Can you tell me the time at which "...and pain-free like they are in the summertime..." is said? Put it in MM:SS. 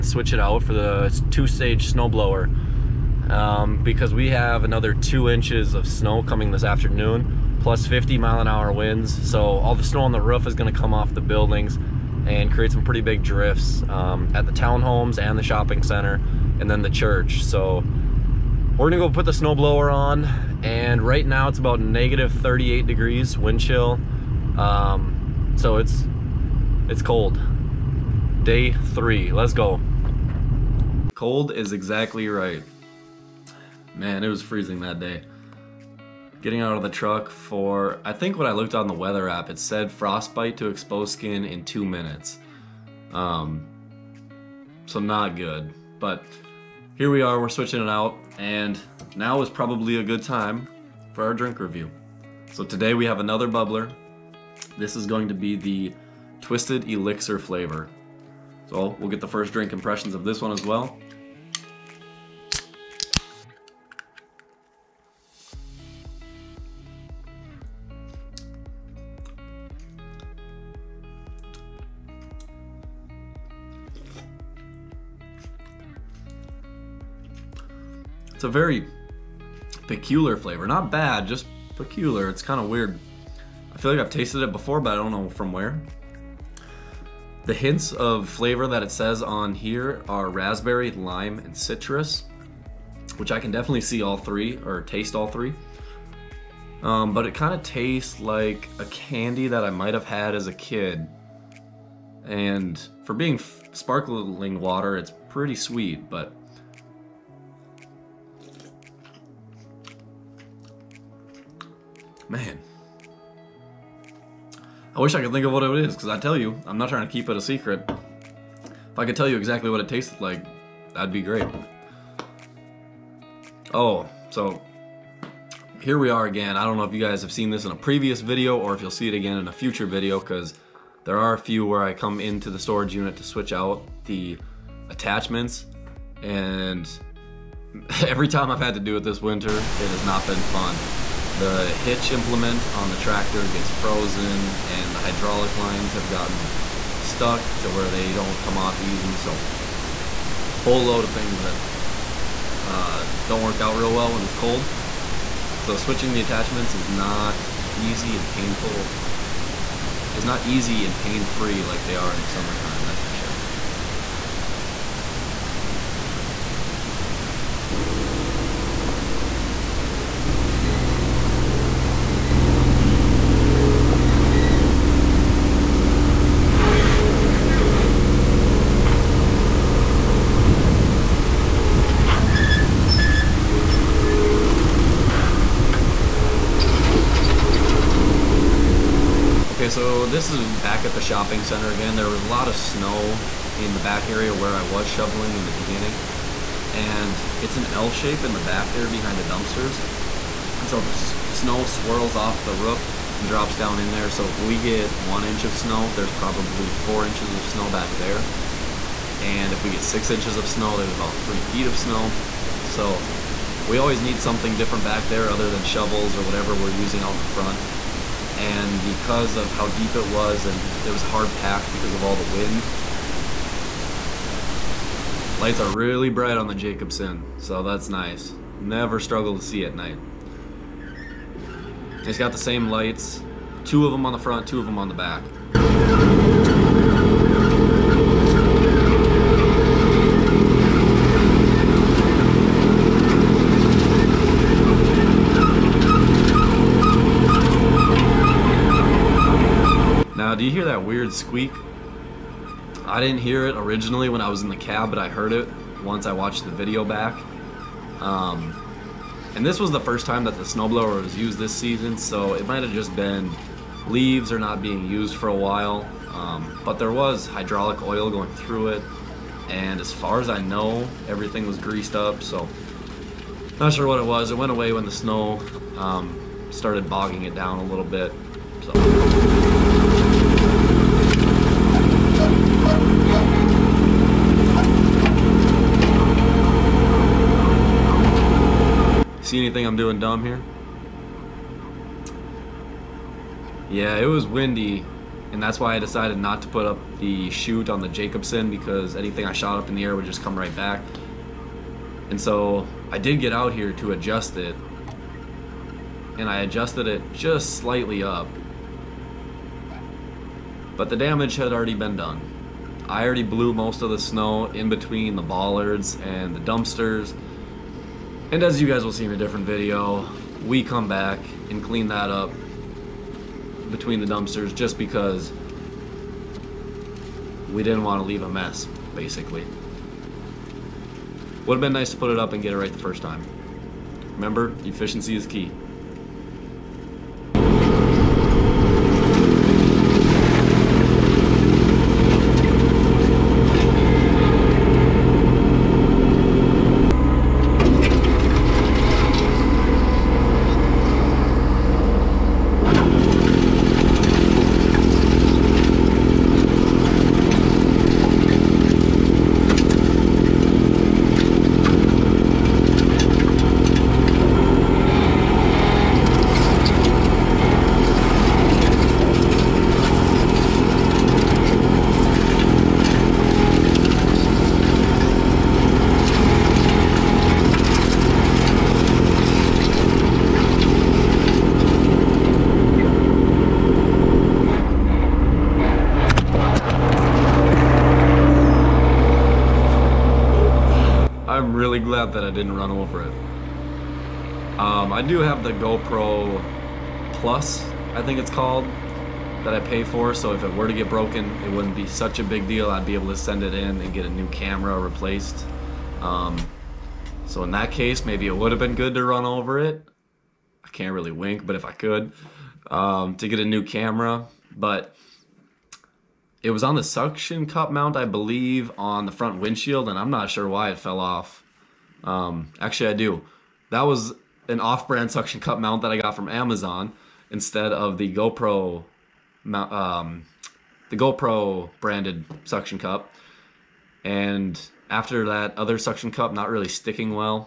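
02:40.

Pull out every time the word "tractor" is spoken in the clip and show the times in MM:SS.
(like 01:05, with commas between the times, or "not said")
02:22.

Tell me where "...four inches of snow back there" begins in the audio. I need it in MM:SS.
03:26.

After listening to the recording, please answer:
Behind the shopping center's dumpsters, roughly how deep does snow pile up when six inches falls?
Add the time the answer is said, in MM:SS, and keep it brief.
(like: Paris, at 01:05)
3 feet, at 03:31.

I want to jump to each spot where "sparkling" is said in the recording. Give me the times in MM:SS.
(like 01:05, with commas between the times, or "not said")
01:43.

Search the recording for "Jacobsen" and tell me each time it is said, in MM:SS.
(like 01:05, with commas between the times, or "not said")
03:46, 04:57.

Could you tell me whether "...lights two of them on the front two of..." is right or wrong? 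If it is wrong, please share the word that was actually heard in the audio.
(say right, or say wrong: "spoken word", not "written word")
right.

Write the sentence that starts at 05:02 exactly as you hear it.
And so I did get out here to adjust it, and I adjusted it just slightly up.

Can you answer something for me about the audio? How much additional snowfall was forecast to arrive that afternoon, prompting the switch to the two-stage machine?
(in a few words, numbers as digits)
2 inches.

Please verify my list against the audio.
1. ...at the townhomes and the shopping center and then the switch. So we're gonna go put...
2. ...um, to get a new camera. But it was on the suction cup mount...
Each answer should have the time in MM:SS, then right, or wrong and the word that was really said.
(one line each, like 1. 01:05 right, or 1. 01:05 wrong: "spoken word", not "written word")
1. 00:14 wrong: "church", not "switch"
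2. 06:52 right.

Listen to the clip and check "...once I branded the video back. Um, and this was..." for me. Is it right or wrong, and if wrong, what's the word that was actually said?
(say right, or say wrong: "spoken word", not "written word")
wrong: "watched", not "branded".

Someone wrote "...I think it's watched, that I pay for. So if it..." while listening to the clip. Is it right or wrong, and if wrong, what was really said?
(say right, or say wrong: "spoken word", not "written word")
wrong: "called", not "watched".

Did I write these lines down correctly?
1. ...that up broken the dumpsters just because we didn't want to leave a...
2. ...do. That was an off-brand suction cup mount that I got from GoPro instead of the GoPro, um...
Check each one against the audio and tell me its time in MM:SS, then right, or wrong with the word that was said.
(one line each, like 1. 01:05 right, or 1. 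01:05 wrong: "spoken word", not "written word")
1. 05:21 wrong: "between", not "broken"
2. 07:02 wrong: "Amazon", not "GoPro".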